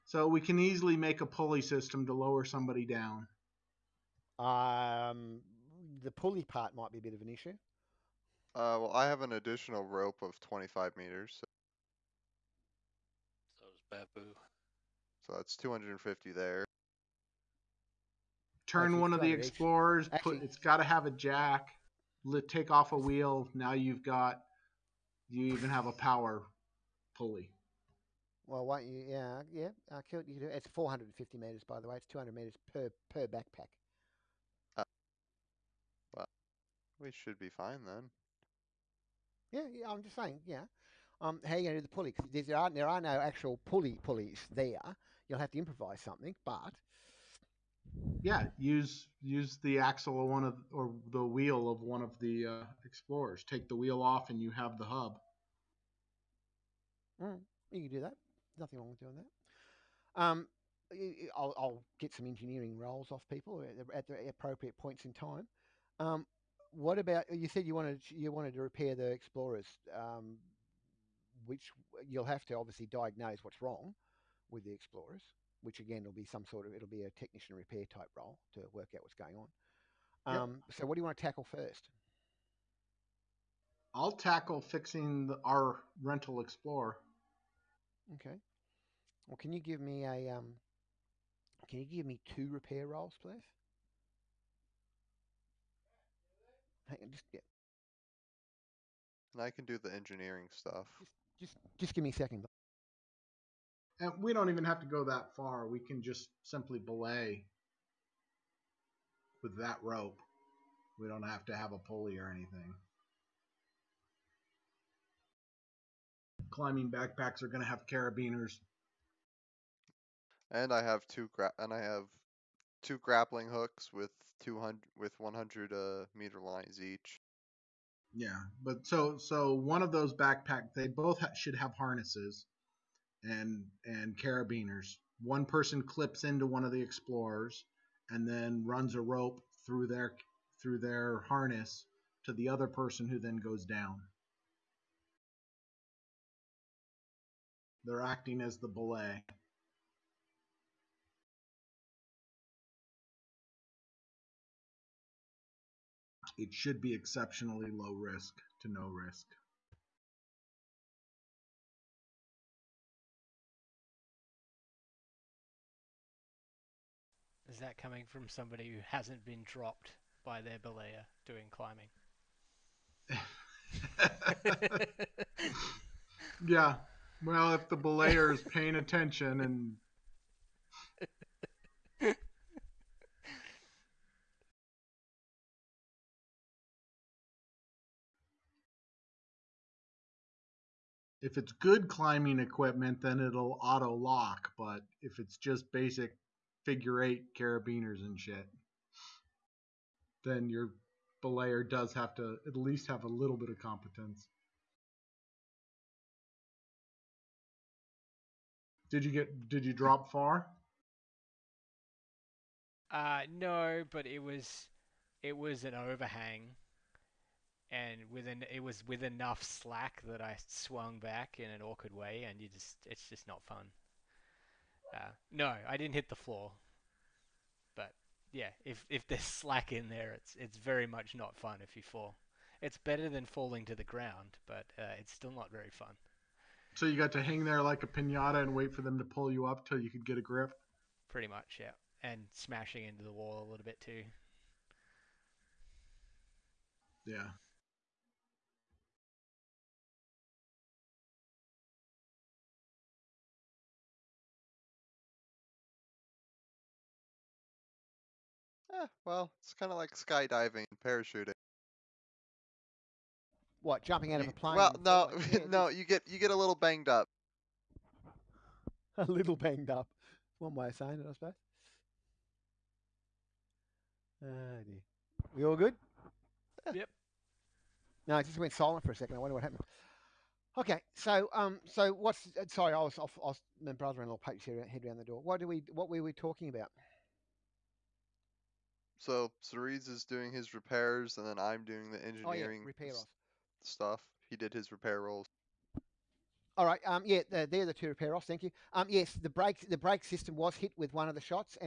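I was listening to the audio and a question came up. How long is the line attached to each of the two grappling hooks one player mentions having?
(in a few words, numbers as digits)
100 meters.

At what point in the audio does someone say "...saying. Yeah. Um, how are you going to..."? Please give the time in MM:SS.
00:40.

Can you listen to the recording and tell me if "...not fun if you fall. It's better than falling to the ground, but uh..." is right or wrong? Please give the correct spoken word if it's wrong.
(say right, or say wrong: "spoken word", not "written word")
right.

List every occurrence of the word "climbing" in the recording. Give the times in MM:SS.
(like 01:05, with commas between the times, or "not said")
01:56, 02:51, 03:11.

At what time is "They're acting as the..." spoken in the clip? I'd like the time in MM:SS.
02:27.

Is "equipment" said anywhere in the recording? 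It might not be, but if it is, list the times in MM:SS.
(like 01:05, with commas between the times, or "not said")
03:12.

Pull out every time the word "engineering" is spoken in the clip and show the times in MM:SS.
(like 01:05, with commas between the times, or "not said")
01:02, 01:39, 04:51.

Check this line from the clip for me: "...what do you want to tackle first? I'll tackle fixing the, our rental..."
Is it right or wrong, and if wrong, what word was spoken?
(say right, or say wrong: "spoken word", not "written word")
right.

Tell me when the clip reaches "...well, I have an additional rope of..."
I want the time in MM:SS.
00:08.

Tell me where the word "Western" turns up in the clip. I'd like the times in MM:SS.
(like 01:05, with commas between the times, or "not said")
not said.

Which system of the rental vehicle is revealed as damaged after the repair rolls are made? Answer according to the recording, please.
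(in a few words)
The brake system.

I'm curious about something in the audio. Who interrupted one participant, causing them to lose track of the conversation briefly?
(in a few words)
Brother-in-law.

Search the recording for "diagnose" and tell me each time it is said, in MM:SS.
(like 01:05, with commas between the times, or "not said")
01:12.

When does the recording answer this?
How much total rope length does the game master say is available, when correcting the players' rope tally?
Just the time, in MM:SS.
00:30.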